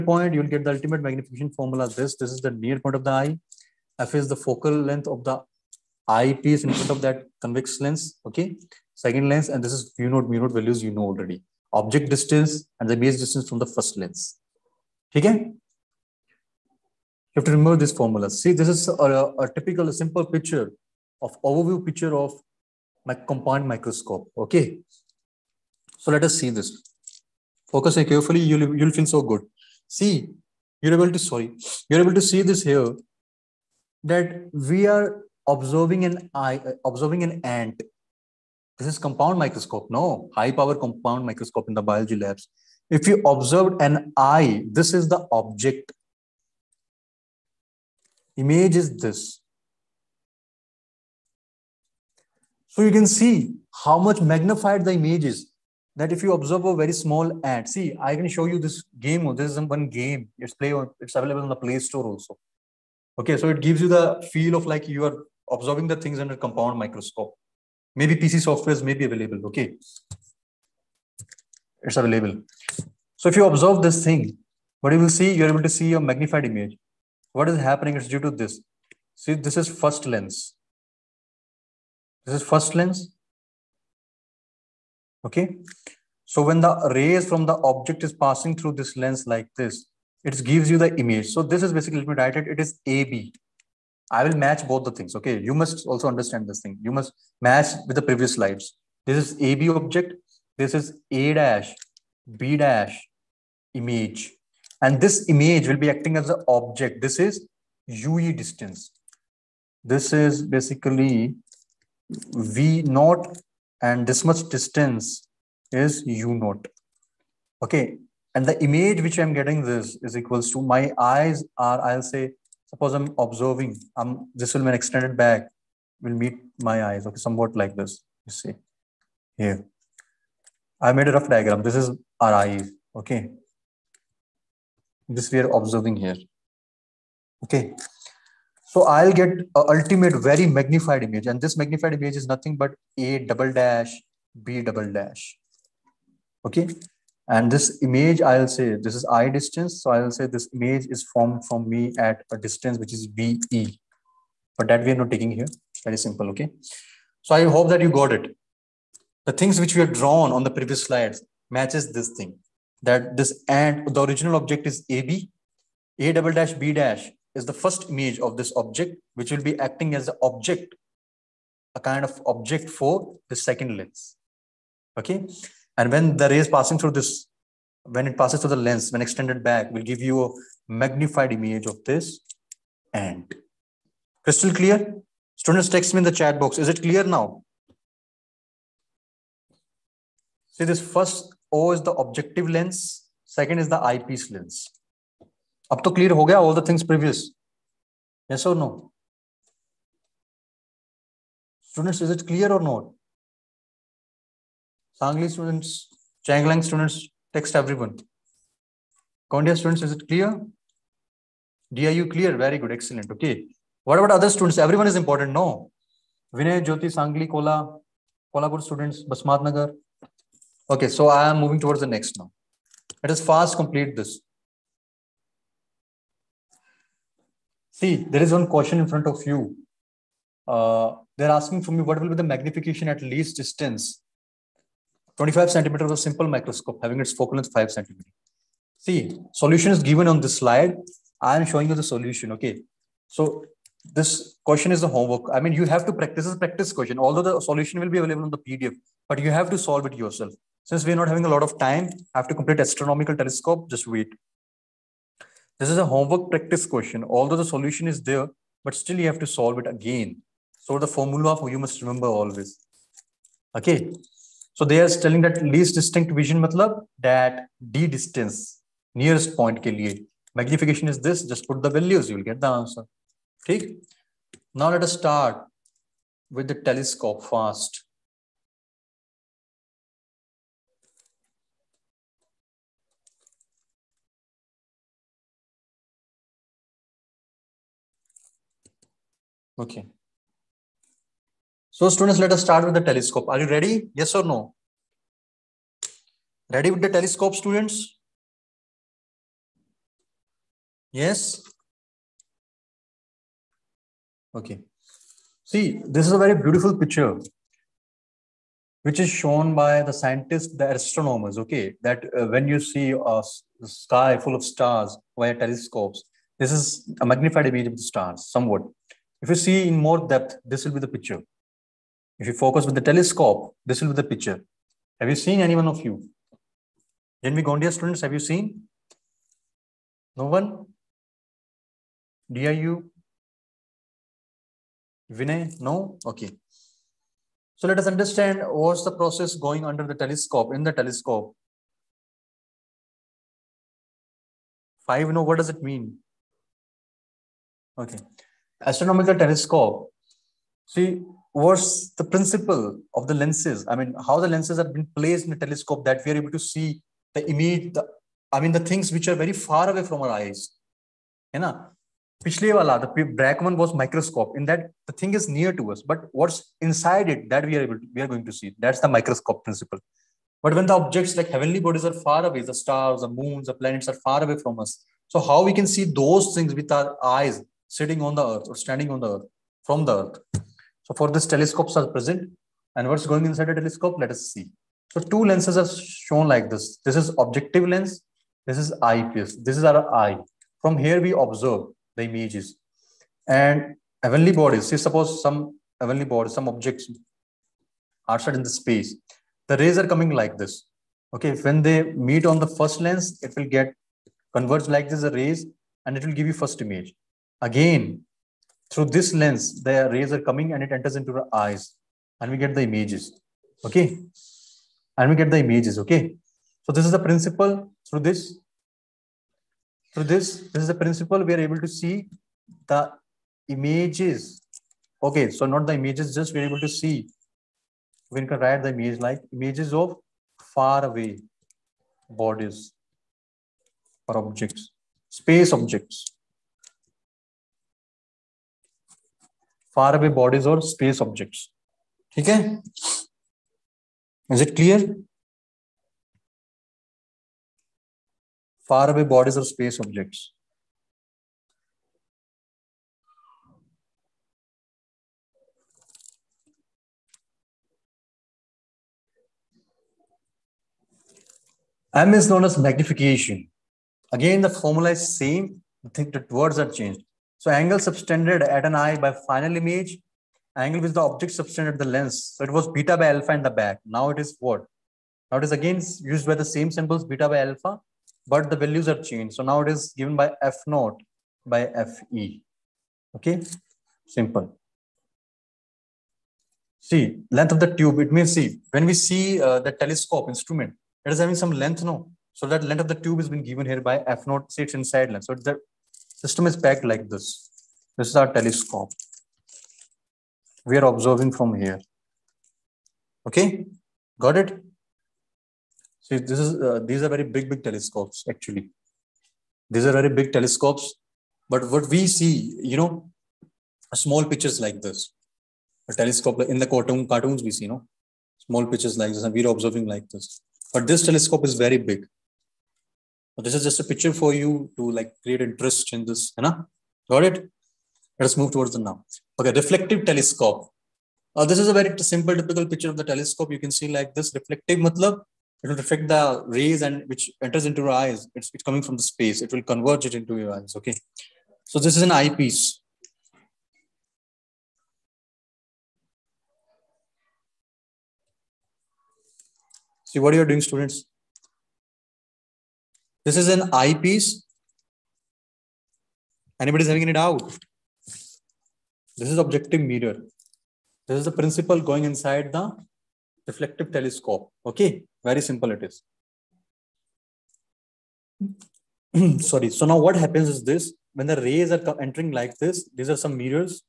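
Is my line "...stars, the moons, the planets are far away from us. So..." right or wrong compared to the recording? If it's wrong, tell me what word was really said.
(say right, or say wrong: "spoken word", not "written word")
right.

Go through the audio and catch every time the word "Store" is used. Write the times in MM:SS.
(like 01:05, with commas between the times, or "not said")
01:01.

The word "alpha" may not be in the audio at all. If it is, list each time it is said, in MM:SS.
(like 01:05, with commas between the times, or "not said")
07:53, 07:57.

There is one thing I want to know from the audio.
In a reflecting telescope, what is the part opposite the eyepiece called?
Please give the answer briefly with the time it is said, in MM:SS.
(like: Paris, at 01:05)
Objective mirror, at 09:19.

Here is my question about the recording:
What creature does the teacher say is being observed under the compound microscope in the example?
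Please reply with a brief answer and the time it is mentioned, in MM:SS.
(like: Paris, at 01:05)
An ant, at 00:37.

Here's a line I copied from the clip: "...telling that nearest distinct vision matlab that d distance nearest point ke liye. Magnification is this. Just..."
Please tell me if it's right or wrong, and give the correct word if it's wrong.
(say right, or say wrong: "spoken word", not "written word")
wrong: "least", not "nearest".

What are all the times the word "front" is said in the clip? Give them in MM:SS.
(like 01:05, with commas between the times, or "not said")
00:06, 03:48.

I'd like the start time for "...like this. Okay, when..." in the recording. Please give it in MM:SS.
06:40.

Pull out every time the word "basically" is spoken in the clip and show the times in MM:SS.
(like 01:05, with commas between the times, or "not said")
01:31, 01:50.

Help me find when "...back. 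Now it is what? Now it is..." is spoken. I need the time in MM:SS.
07:53.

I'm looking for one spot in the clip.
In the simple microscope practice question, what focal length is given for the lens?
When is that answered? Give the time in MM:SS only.
03:57.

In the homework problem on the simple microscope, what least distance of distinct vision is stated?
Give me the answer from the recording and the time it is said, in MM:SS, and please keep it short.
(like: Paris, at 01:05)
25 centimeters, at 03:55.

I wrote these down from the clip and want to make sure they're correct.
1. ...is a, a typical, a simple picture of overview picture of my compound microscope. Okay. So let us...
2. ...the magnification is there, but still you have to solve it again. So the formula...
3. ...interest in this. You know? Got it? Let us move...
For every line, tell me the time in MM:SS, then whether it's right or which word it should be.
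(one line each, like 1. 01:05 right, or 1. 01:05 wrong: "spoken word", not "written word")
1. 00:18 right
2. 04:17 wrong: "solution", not "magnification"
3. 08:45 right.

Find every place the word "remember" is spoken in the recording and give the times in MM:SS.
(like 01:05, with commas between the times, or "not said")
00:17, 04:21.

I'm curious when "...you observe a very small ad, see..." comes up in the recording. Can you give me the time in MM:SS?
00:56.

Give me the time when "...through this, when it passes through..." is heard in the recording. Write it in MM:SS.
02:56.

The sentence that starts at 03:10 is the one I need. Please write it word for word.
See this first O is the objective lens.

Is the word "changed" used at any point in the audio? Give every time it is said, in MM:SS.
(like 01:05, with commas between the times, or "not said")
07:46, 07:59.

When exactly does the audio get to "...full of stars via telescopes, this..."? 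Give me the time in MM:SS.
05:14.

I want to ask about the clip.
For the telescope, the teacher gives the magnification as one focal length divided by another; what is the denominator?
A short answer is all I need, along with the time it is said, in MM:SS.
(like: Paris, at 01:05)
Fe, at 08:01.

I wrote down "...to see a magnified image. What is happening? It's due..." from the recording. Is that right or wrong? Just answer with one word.
right.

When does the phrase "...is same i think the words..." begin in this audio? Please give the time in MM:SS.
07:44.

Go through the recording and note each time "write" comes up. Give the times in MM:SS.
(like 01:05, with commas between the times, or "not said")
01:32, 07:08.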